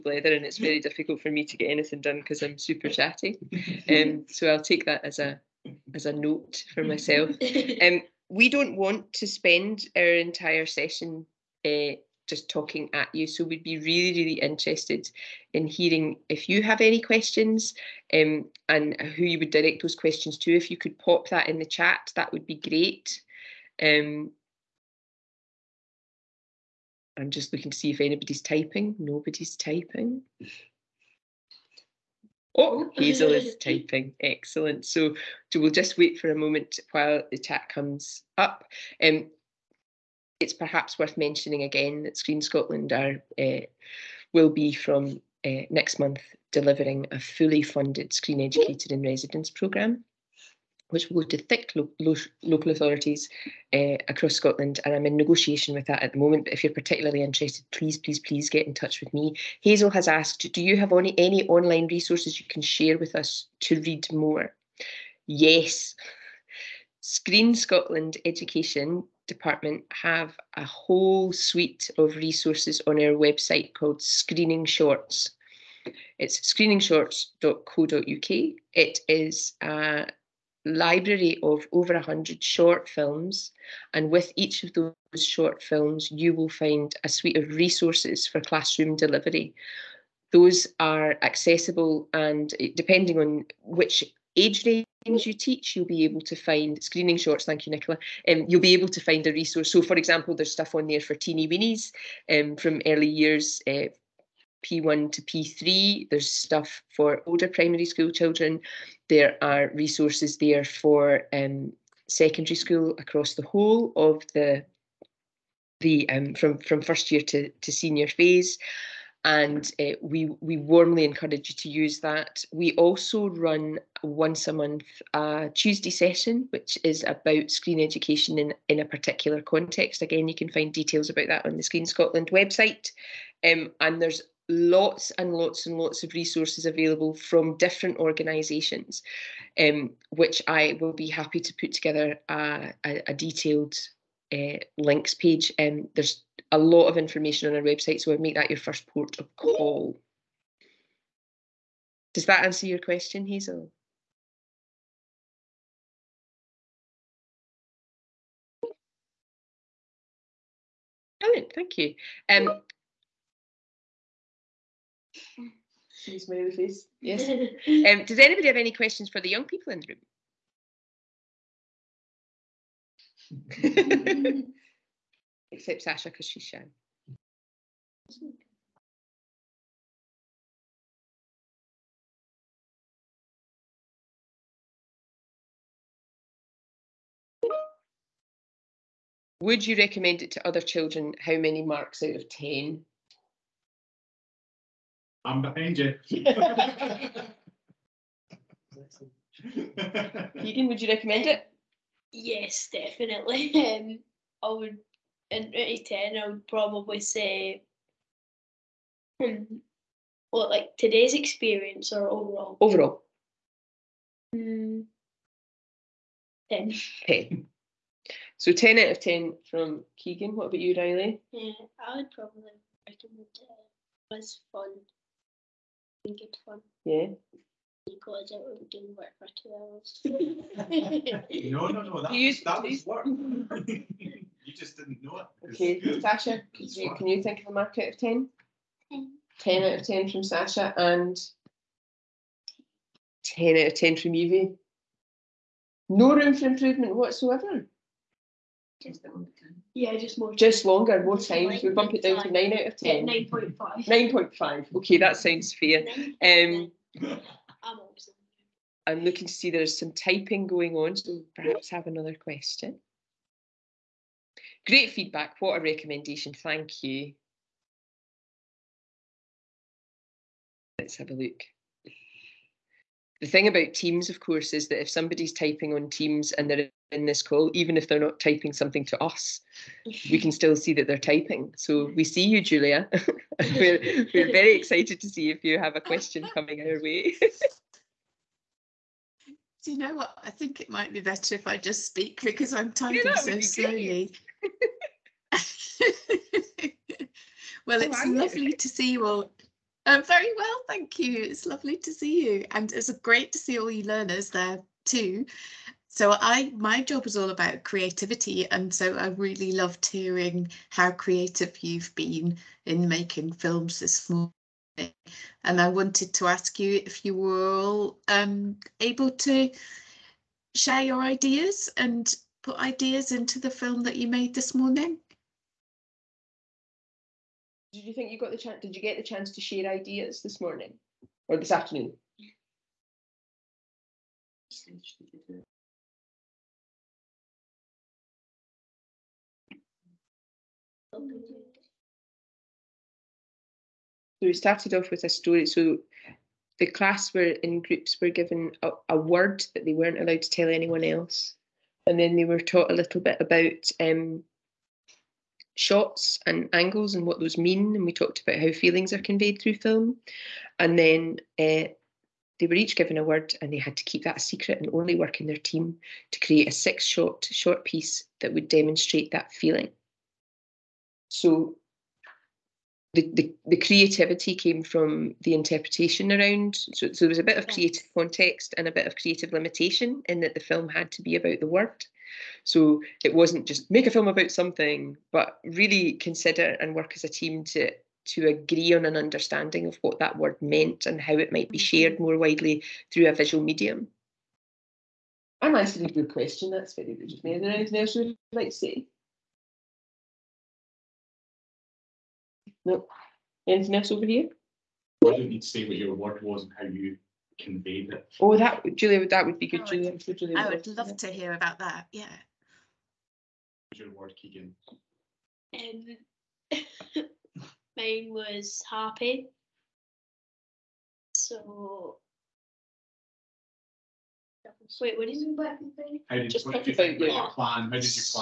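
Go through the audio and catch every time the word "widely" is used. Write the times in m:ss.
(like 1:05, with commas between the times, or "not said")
6:32.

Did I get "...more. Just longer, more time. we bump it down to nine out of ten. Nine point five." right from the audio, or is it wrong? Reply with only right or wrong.
right.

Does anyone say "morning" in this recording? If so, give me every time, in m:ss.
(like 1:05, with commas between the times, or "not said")
5:14, 5:24, 5:30.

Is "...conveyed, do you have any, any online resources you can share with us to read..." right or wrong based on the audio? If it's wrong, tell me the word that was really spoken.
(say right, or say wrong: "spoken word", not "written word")
wrong: "asked", not "conveyed".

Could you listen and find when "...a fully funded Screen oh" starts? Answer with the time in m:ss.
0:47.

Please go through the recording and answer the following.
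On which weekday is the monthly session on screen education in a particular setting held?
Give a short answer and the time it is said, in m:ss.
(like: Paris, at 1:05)
Tuesday, at 2:05.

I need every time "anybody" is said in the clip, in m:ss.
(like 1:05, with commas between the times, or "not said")
0:27, 2:48.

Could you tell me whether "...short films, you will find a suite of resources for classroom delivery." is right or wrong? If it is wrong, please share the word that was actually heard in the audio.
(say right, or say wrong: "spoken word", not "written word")
right.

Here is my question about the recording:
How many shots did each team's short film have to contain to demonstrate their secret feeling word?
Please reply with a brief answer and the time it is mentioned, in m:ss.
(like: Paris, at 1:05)
6, at 6:06.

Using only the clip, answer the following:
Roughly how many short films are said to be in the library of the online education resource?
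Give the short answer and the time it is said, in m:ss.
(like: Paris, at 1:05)
over 100, at 1:21.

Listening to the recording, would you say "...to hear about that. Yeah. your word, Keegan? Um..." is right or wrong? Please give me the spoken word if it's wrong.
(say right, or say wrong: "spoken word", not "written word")
right.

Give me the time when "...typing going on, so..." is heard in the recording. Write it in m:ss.
4:19.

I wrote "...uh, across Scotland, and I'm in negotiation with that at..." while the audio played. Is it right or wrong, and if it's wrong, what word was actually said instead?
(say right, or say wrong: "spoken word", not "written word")
right.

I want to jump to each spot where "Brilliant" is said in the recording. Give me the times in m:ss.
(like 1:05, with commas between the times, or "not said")
2:41.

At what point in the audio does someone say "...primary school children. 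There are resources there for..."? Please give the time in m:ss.
1:47.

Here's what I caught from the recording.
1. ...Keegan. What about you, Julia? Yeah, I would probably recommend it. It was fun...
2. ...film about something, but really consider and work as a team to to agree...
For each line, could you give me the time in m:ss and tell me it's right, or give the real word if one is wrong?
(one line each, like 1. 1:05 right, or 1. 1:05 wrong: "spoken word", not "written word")
1. 3:39 wrong: "Riley", not "Julia"
2. 6:23 right.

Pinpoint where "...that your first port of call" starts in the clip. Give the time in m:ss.
2:28.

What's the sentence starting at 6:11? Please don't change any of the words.
So the, the, the, creativity came from the interpretation around.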